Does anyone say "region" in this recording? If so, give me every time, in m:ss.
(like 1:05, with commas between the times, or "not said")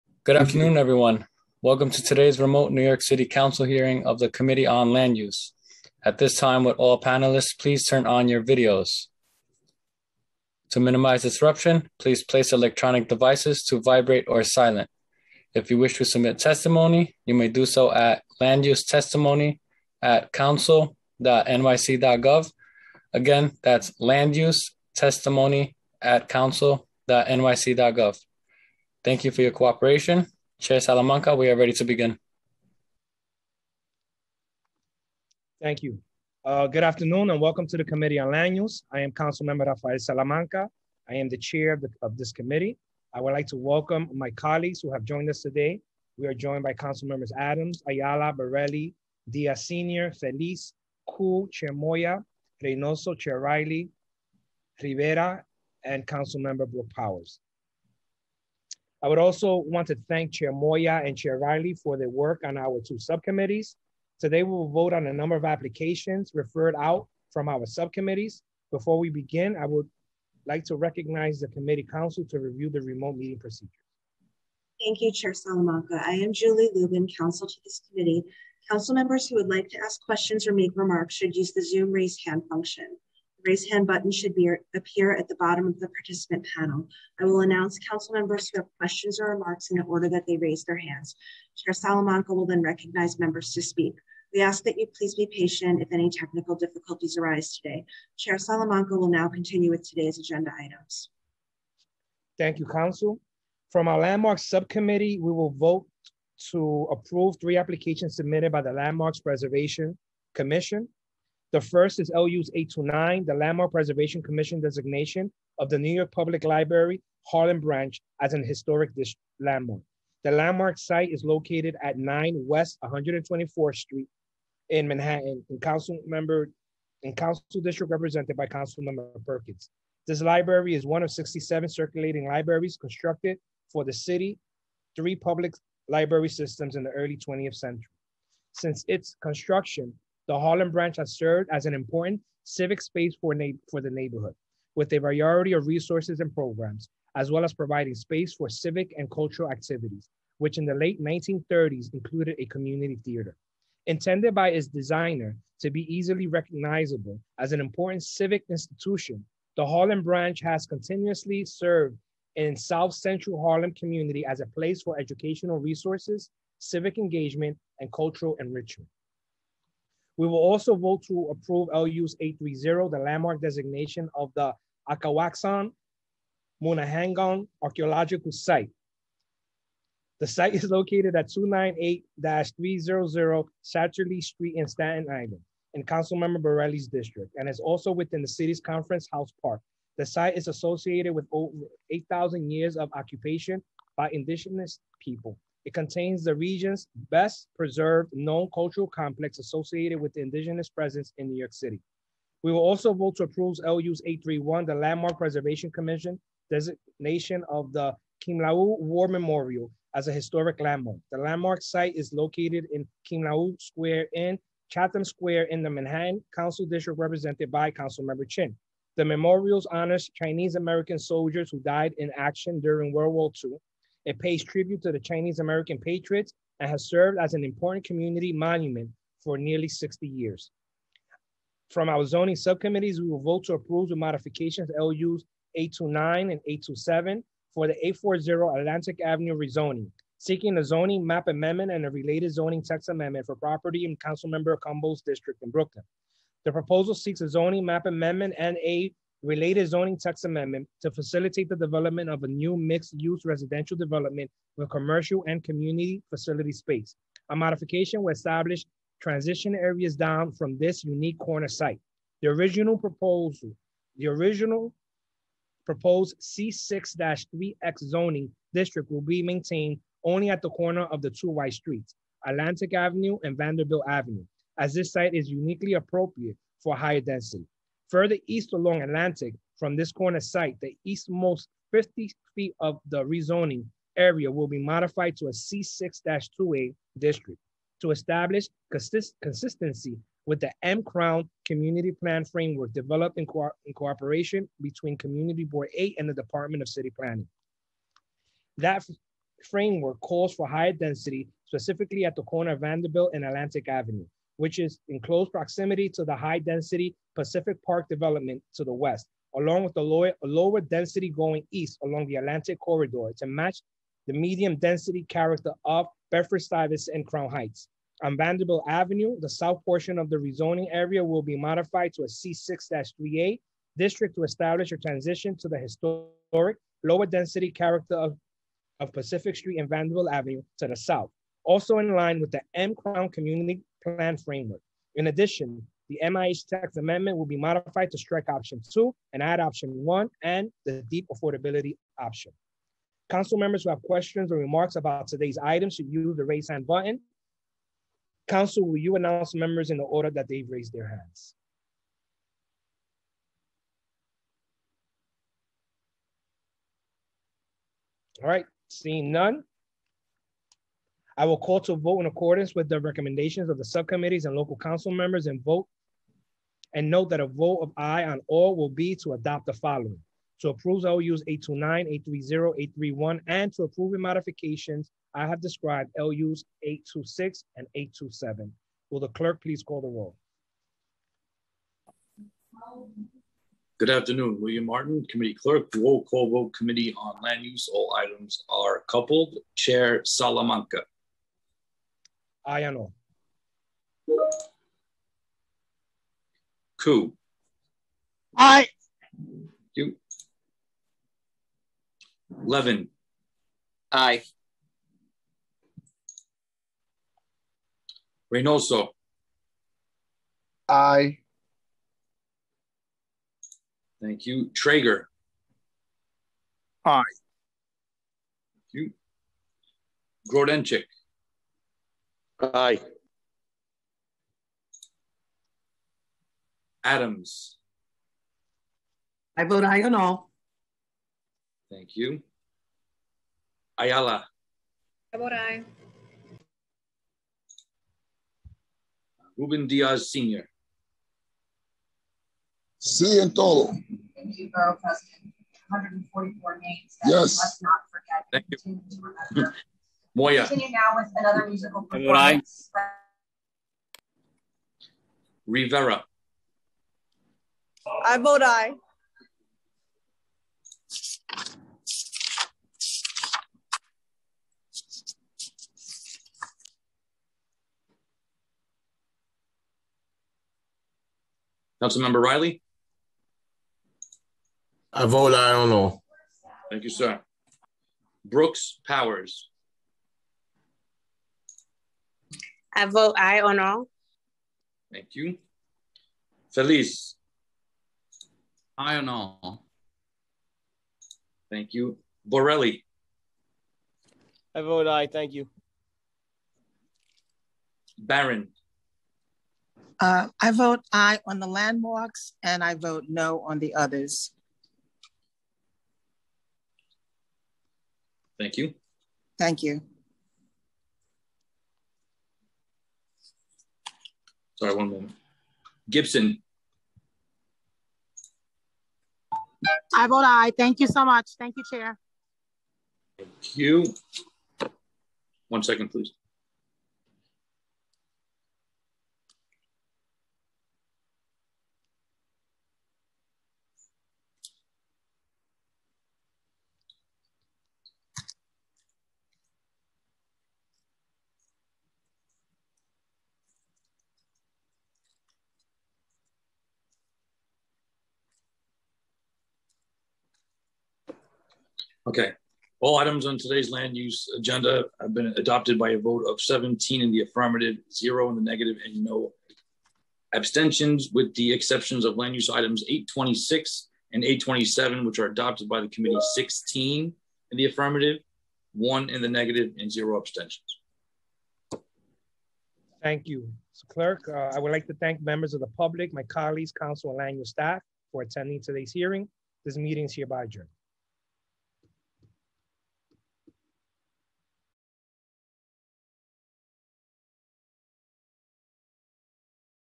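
3:16.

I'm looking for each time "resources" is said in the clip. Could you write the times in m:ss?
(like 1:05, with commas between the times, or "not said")
2:25, 2:45.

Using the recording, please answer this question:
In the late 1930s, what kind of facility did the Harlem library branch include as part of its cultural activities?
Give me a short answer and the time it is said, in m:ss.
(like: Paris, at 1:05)
community theater, at 2:32.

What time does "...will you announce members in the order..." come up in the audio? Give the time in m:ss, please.
5:48.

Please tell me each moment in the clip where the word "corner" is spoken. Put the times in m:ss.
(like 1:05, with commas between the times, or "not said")
4:21, 4:30, 4:39, 5:02.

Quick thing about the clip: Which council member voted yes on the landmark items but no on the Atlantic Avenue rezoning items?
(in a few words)
Barron.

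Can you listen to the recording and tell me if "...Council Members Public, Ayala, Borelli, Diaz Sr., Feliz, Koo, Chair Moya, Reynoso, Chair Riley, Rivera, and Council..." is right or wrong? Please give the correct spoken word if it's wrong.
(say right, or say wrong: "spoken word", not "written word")
wrong: "Adams", not "Public".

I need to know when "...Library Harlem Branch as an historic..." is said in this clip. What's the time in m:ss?
1:56.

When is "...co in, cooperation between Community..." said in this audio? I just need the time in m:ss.
4:53.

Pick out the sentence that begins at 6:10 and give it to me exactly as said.
To approve LUs 829, 830, 831, and to approve the modifications I have described LUs 826 and 827.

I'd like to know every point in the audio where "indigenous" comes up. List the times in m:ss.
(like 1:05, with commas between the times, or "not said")
3:14, 3:20.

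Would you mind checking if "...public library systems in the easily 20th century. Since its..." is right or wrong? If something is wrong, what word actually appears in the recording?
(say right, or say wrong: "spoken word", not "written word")
wrong: "early", not "easily".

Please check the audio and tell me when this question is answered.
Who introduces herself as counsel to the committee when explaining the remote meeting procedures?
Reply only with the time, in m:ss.
1:16.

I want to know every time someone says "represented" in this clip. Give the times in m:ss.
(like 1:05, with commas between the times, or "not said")
2:07, 3:36.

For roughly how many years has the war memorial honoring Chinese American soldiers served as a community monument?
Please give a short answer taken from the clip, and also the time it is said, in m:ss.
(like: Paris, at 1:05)
60, at 3:49.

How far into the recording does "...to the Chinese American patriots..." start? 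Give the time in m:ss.
3:44.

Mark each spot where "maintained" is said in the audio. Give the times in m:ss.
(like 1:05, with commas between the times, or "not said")
4:29.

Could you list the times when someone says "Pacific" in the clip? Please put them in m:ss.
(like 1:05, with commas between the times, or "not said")
5:07, 5:28.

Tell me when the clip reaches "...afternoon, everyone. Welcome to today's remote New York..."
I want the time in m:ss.
0:00.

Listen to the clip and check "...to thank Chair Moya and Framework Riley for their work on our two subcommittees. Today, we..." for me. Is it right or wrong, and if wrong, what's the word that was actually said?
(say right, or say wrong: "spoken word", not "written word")
wrong: "Chair", not "Framework".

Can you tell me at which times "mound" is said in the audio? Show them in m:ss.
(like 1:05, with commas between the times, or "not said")
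not said.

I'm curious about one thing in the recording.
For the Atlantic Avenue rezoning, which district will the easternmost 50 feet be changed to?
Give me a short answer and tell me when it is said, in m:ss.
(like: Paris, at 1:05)
C6-2A, at 4:45.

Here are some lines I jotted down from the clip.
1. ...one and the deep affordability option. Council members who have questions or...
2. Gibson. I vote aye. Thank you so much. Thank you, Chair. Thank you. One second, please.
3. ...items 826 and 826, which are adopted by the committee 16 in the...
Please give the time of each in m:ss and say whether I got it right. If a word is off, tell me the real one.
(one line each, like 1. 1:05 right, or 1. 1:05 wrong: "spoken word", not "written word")
1. 5:39 right
2. 8:35 right
3. 9:22 wrong: "827", not "826".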